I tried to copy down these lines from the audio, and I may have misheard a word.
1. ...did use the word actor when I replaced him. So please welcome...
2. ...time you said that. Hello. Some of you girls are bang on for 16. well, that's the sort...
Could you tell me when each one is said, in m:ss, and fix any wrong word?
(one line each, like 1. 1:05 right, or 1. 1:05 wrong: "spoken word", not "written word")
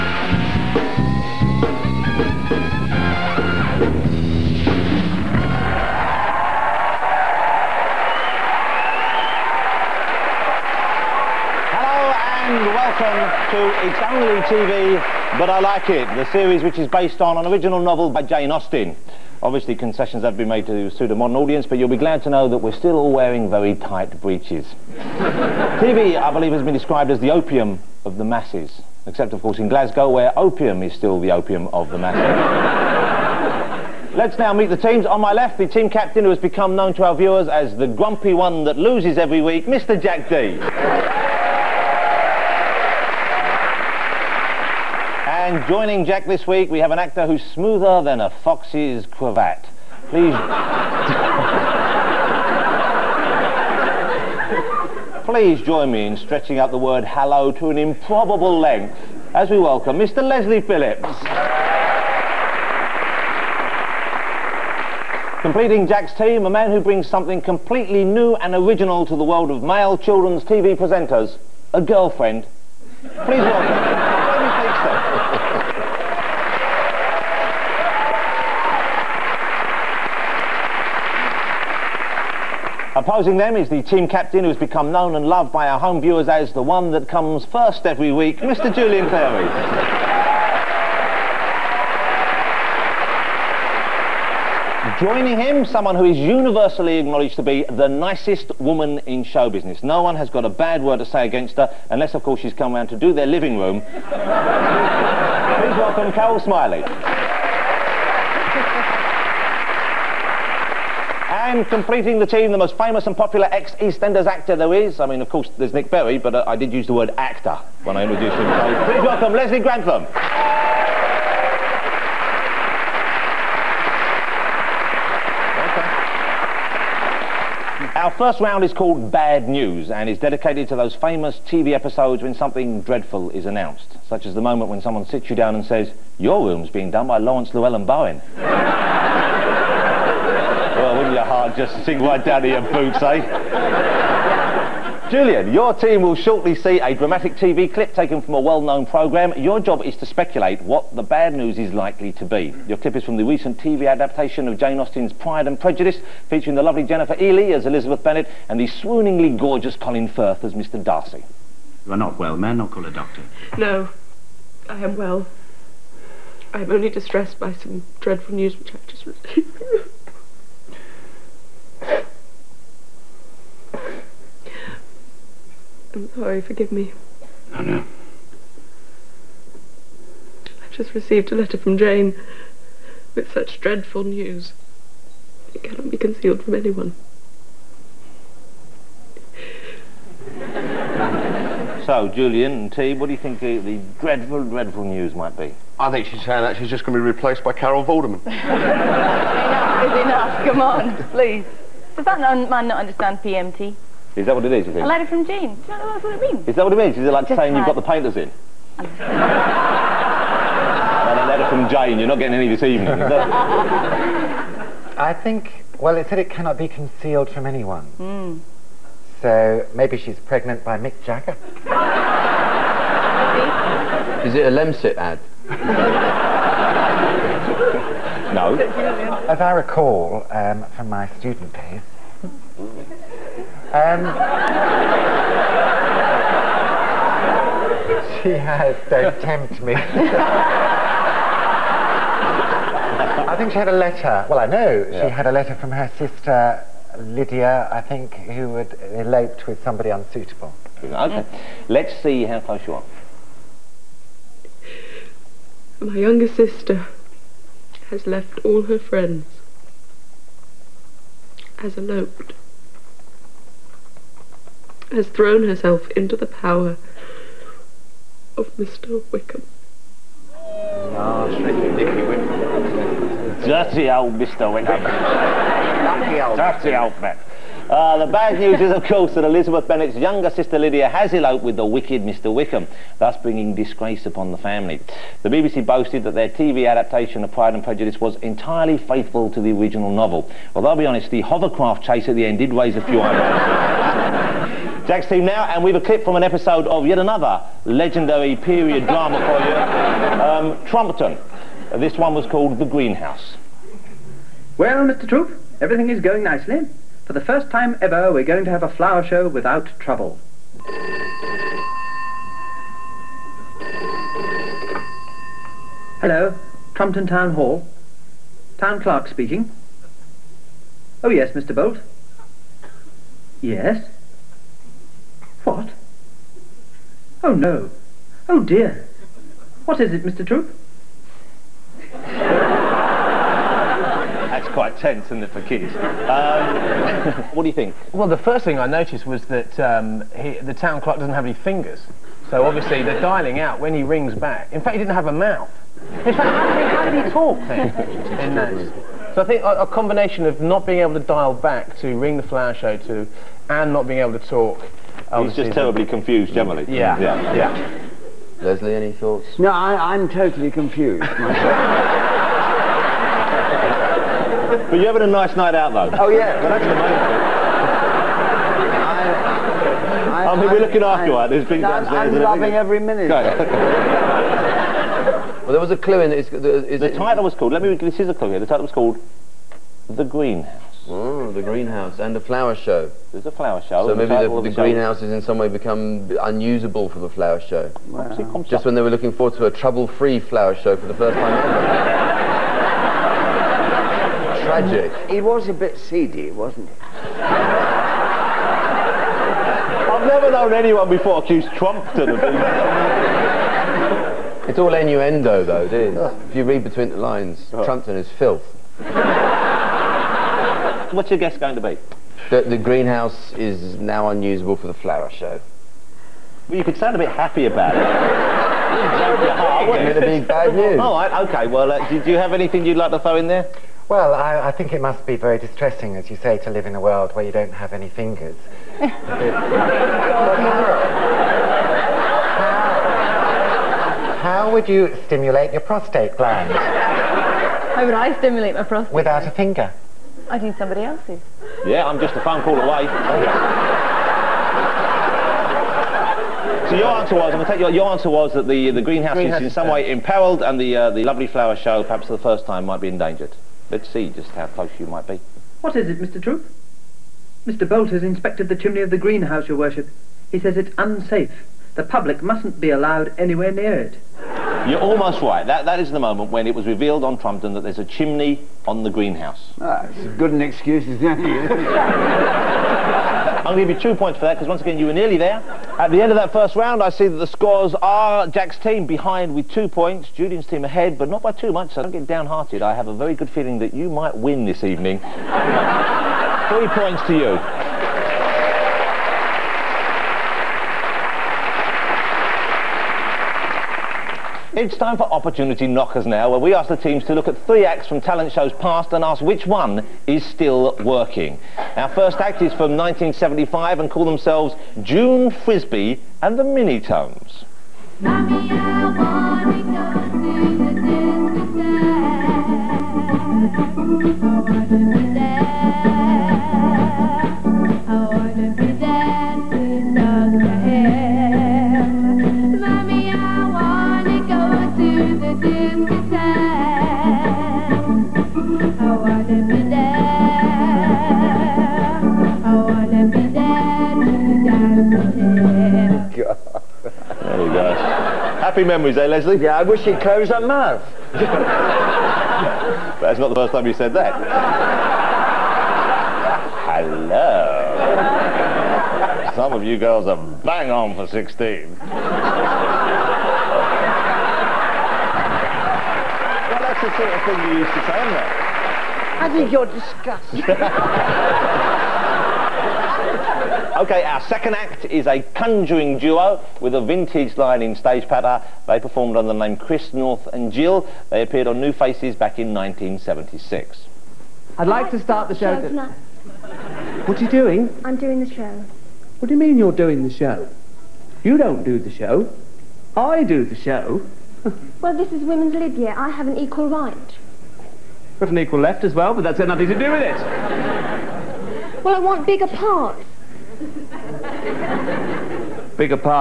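1. 1:56 wrong: "introduced", not "replaced"
2. 9:03 right.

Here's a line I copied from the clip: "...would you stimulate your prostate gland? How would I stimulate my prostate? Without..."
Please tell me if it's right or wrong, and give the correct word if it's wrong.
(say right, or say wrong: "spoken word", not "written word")
right.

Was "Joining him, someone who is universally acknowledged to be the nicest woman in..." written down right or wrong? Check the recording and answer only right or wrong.
right.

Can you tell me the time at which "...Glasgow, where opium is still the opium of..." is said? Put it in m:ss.
0:29.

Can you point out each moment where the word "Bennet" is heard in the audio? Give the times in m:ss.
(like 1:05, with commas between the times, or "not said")
2:38, 4:39.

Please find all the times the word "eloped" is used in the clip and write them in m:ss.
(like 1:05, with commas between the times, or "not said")
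4:08, 4:21, 4:41.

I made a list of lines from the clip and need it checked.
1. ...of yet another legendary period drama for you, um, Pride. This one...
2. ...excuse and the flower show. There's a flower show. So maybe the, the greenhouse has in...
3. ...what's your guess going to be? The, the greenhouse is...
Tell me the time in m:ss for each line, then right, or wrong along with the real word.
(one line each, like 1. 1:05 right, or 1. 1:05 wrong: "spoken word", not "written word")
1. 4:56 wrong: "Trumpton", not "Pride"
2. 6:21 wrong: "greenhouse", not "excuse"
3. 6:51 right.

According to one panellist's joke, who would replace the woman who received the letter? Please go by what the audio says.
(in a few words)
Carol Vorderman.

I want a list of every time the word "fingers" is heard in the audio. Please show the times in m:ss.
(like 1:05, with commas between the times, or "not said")
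5:41, 7:07, 7:19.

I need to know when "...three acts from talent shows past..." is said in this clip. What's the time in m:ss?
8:17.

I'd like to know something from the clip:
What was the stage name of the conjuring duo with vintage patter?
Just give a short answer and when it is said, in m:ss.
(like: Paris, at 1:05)
Chris North and Jill, at 9:29.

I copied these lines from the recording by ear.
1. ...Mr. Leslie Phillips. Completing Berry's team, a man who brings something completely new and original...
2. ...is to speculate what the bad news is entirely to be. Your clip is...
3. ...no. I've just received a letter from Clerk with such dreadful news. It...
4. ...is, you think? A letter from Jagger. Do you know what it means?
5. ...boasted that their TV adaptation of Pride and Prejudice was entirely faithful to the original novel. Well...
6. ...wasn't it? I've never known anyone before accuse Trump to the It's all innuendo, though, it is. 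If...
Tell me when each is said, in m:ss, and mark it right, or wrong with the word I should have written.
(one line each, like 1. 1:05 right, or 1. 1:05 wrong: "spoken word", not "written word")
1. 0:59 wrong: "Jack", not "Berry"
2. 2:29 wrong: "likely", not "entirely"
3. 2:57 wrong: "Jane", not "Clerk"
4. 3:24 wrong: "Jane", not "Jagger"
5. 4:45 right
6. 6:36 right.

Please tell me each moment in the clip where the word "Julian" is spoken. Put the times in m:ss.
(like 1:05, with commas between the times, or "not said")
1:28, 2:25, 3:12, 8:00.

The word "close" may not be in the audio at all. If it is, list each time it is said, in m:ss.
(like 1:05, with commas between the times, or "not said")
4:12, 7:34, 9:00.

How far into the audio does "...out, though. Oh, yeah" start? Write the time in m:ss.
6:05.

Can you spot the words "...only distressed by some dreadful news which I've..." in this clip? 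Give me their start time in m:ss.
2:46.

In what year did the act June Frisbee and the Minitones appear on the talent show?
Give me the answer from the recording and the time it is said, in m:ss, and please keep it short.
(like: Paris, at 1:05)
1975, at 8:22.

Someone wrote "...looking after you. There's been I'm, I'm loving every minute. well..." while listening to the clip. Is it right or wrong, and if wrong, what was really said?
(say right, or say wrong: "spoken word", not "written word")
right.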